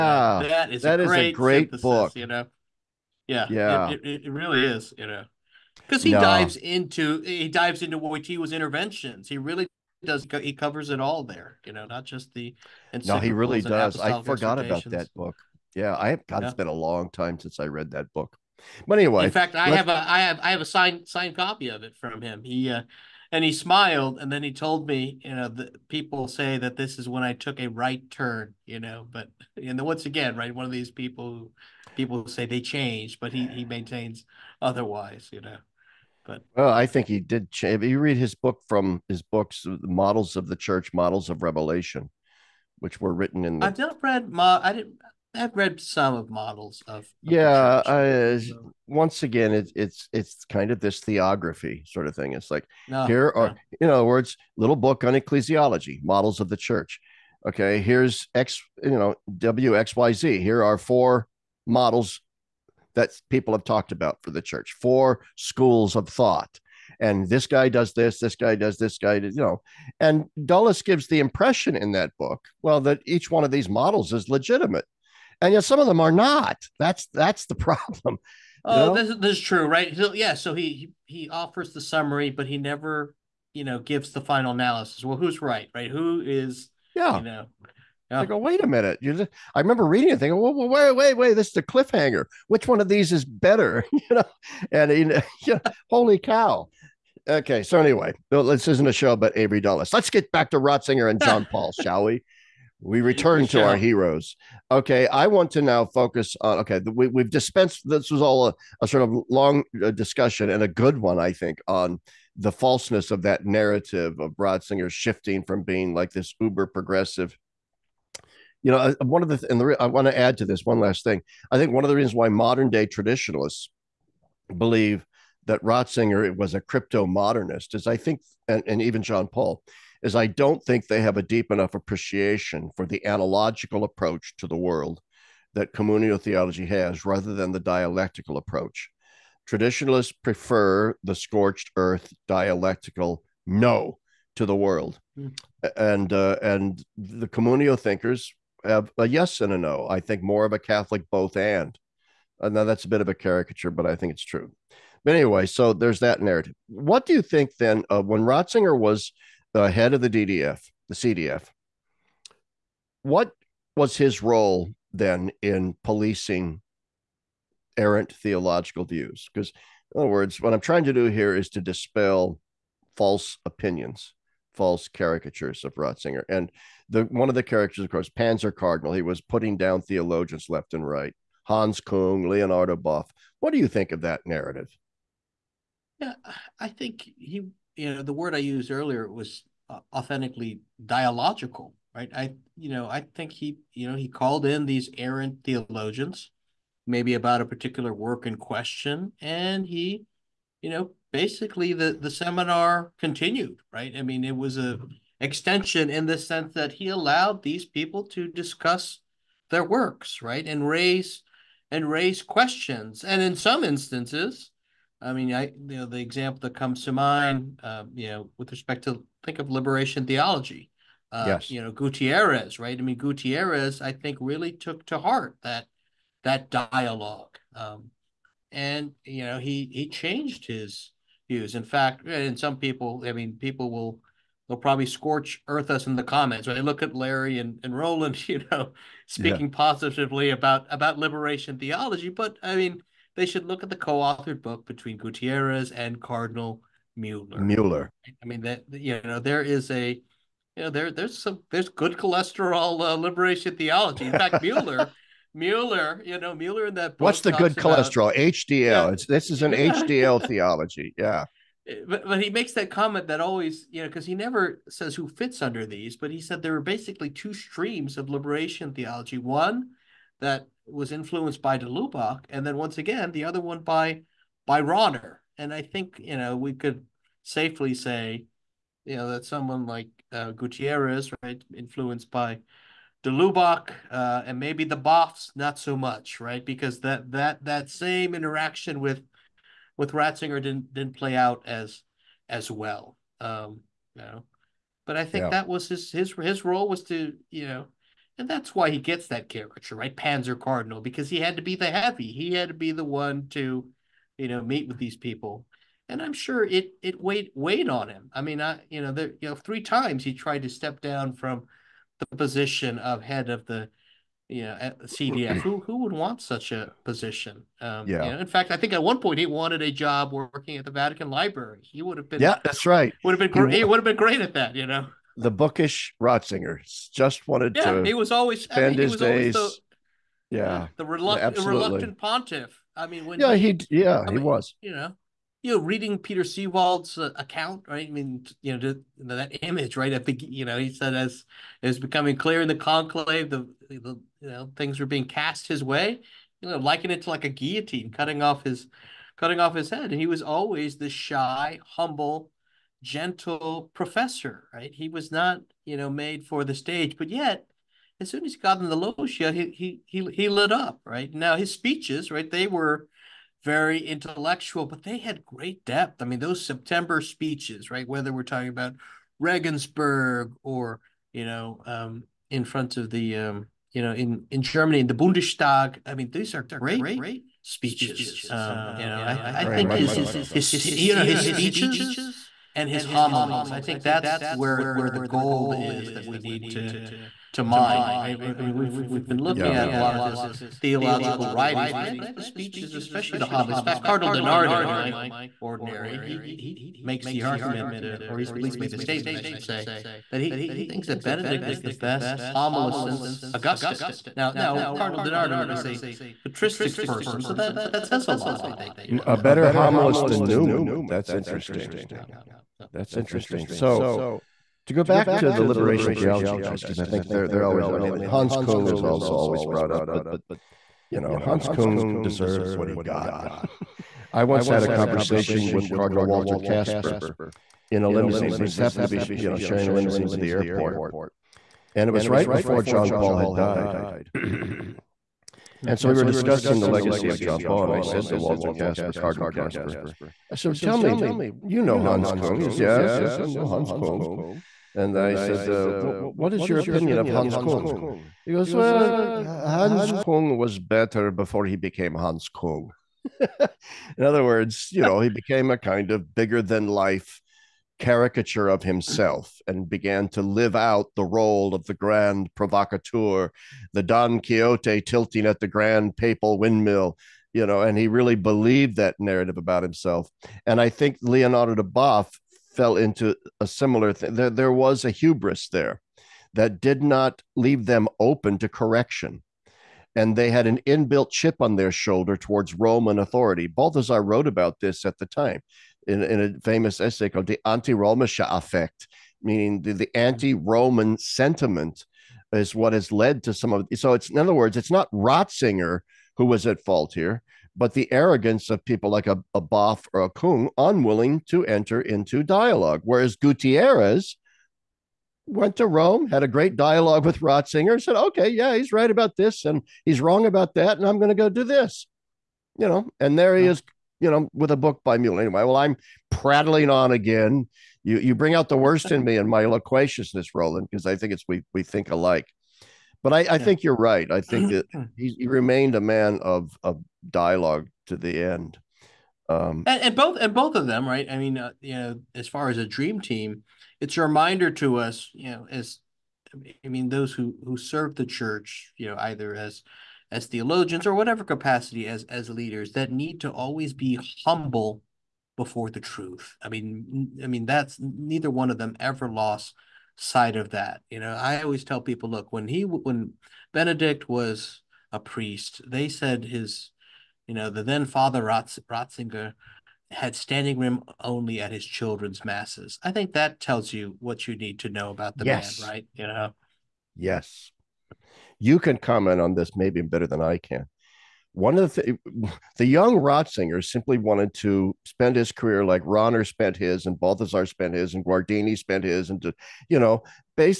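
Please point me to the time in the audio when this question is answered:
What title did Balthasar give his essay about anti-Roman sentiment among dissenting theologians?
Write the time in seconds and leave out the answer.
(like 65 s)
487 s.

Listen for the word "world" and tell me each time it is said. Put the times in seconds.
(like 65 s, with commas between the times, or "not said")
134 s, 144 s.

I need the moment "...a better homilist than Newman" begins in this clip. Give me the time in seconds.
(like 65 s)
409 s.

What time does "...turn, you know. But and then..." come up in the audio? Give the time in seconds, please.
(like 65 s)
28 s.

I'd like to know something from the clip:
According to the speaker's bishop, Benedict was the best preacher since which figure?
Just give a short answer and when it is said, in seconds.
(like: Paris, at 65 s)
Augustine, at 403 s.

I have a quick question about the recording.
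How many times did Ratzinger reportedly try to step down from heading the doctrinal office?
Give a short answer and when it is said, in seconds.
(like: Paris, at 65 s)
3, at 309 s.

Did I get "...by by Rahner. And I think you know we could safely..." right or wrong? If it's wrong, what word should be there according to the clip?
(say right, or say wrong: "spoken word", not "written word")
right.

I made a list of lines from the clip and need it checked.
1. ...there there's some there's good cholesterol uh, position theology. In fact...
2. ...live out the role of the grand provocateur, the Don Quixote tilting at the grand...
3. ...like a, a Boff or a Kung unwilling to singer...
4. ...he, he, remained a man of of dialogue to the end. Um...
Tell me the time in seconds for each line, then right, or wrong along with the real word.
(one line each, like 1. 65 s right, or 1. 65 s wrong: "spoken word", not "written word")
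1. 250 s wrong: "liberation", not "position"
2. 460 s right
3. 498 s wrong: "enter", not "singer"
4. 524 s right.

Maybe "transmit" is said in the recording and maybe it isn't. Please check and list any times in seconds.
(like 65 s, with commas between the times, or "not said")
not said.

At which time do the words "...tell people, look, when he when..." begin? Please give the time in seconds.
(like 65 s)
551 s.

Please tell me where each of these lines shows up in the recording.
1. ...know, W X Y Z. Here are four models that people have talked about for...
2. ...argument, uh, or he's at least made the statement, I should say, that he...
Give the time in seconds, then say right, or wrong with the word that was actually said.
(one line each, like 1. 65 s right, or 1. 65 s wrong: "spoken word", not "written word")
1. 58 s right
2. 397 s right.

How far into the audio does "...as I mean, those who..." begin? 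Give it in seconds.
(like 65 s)
535 s.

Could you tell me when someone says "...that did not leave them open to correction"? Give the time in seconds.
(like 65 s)
476 s.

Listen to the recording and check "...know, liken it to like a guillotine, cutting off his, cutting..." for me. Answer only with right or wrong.
right.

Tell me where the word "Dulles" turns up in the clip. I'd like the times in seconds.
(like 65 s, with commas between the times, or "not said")
70 s, 99 s.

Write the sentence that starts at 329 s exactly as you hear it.
The, yeah, the reluctant, reluctant pontiff.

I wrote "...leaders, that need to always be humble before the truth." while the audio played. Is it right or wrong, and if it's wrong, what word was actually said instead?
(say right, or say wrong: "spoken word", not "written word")
right.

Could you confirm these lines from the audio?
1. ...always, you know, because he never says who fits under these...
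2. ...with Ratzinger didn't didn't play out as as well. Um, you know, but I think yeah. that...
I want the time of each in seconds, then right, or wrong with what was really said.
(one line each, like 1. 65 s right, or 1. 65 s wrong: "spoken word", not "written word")
1. 263 s right
2. 289 s right.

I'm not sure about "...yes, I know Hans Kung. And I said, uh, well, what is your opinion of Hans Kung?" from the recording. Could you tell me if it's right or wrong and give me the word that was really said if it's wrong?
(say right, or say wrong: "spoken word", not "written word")
right.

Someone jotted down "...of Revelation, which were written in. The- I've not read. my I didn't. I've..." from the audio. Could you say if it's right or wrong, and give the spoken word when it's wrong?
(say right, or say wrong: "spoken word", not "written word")
right.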